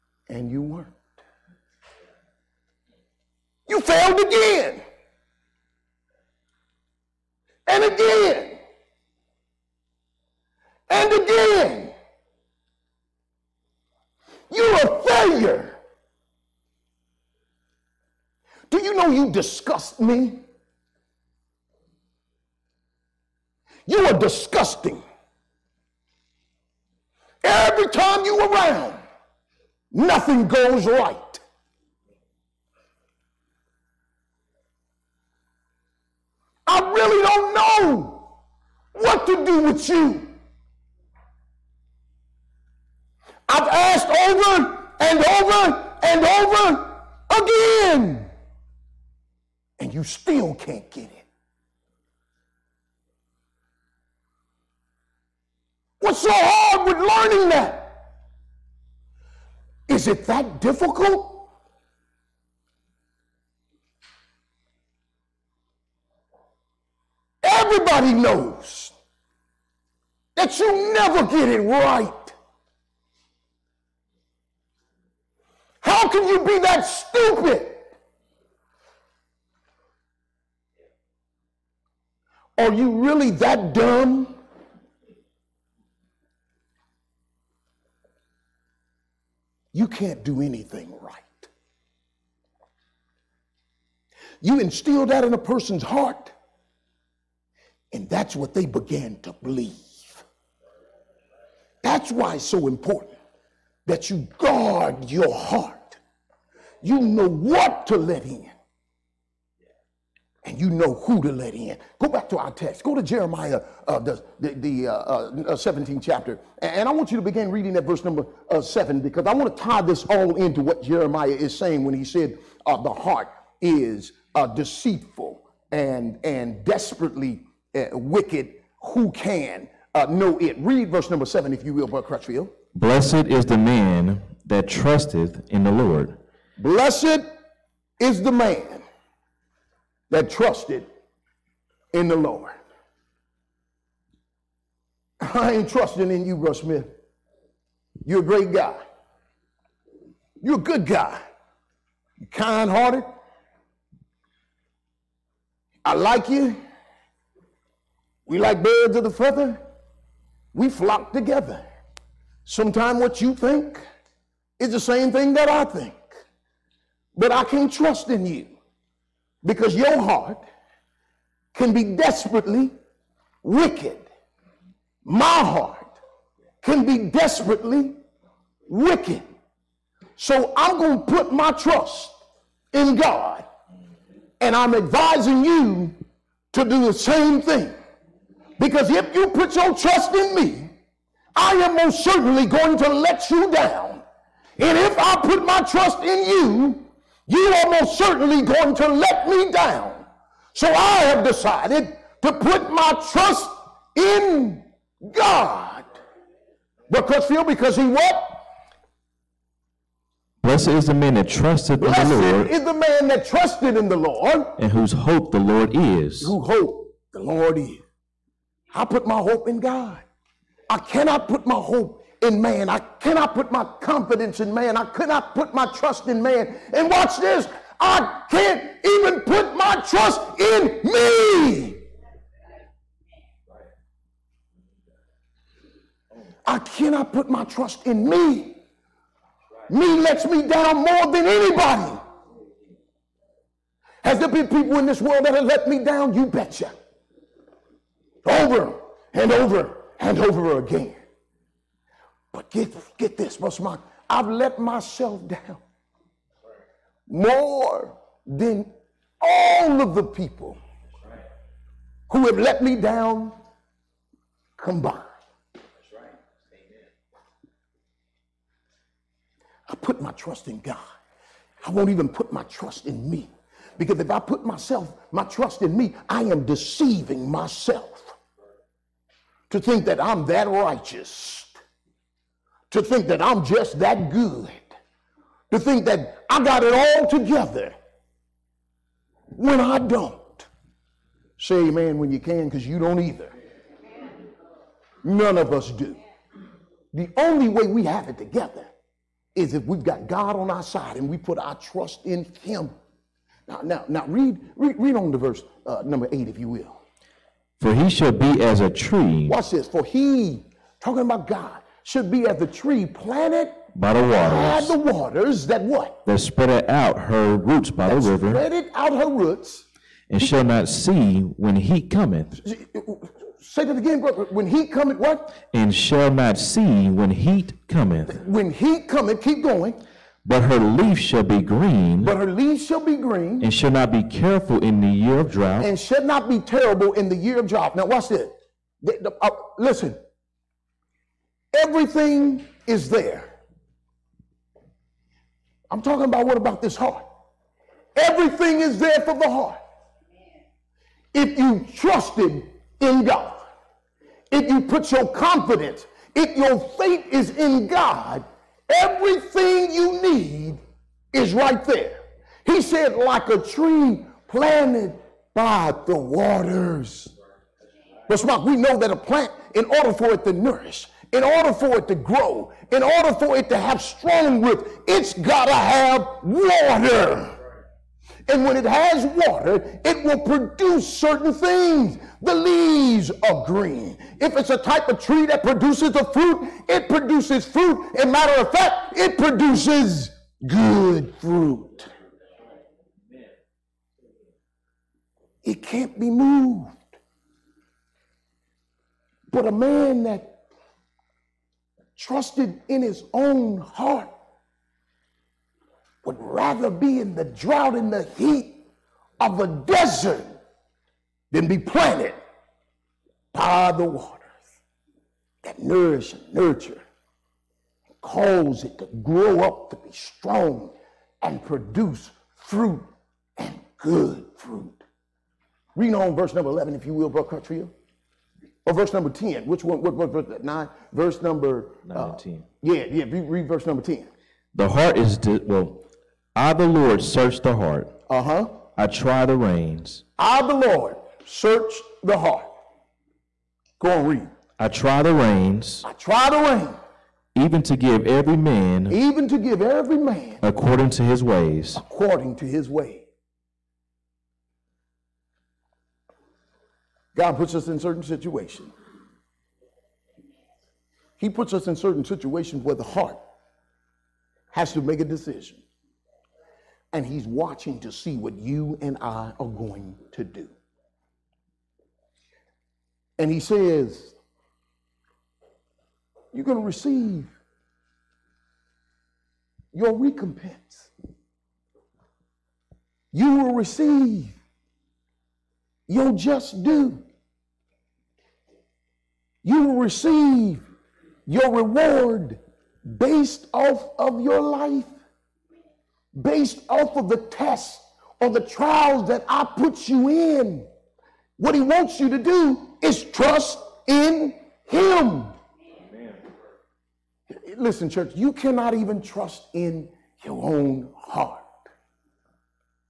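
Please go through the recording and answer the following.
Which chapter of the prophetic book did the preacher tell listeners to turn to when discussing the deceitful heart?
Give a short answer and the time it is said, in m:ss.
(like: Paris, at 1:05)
17th, at 1:55.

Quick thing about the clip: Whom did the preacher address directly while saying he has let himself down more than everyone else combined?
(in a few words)
Brother Mark.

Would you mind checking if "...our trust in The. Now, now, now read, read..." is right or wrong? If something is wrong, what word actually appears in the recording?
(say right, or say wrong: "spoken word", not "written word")
wrong: "Him", not "The".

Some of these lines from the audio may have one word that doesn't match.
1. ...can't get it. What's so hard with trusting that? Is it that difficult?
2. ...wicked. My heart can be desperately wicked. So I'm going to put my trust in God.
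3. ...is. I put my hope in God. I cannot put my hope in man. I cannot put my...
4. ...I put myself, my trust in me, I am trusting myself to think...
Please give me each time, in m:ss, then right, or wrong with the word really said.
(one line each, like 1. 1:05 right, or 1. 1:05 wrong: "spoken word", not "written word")
1. 0:50 wrong: "learning", not "trusting"
2. 2:53 right
3. 3:37 right
4. 4:34 wrong: "deceiving", not "trusting".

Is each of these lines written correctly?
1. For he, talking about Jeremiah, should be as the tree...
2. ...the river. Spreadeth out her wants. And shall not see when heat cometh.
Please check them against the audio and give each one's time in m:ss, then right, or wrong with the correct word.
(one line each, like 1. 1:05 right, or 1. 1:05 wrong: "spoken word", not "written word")
1. 5:09 wrong: "God", not "Jeremiah"
2. 5:18 wrong: "roots", not "wants".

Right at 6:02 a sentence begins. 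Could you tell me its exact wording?
He said, like a tree planted by the waters.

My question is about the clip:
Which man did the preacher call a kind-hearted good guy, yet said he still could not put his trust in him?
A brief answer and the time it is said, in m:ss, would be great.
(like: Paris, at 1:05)
Bro Smith, at 2:26.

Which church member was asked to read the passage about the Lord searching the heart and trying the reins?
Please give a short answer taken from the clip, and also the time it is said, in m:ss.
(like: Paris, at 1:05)
Brother Cutria, at 7:07.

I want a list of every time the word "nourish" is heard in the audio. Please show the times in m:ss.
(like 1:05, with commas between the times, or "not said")
6:10, 6:55.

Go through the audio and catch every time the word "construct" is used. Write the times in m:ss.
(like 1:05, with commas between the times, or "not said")
not said.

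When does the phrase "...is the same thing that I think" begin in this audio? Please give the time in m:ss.
2:44.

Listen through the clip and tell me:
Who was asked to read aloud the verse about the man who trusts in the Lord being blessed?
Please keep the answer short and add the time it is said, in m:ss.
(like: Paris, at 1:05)
Brother Crutchfield, at 2:11.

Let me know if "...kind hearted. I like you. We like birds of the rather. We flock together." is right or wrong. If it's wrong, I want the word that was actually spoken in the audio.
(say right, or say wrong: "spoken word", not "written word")
wrong: "feather", not "rather".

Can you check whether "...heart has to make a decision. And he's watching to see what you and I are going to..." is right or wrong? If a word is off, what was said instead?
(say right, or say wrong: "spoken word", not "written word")
right.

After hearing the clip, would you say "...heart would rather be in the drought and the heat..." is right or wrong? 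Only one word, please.
right.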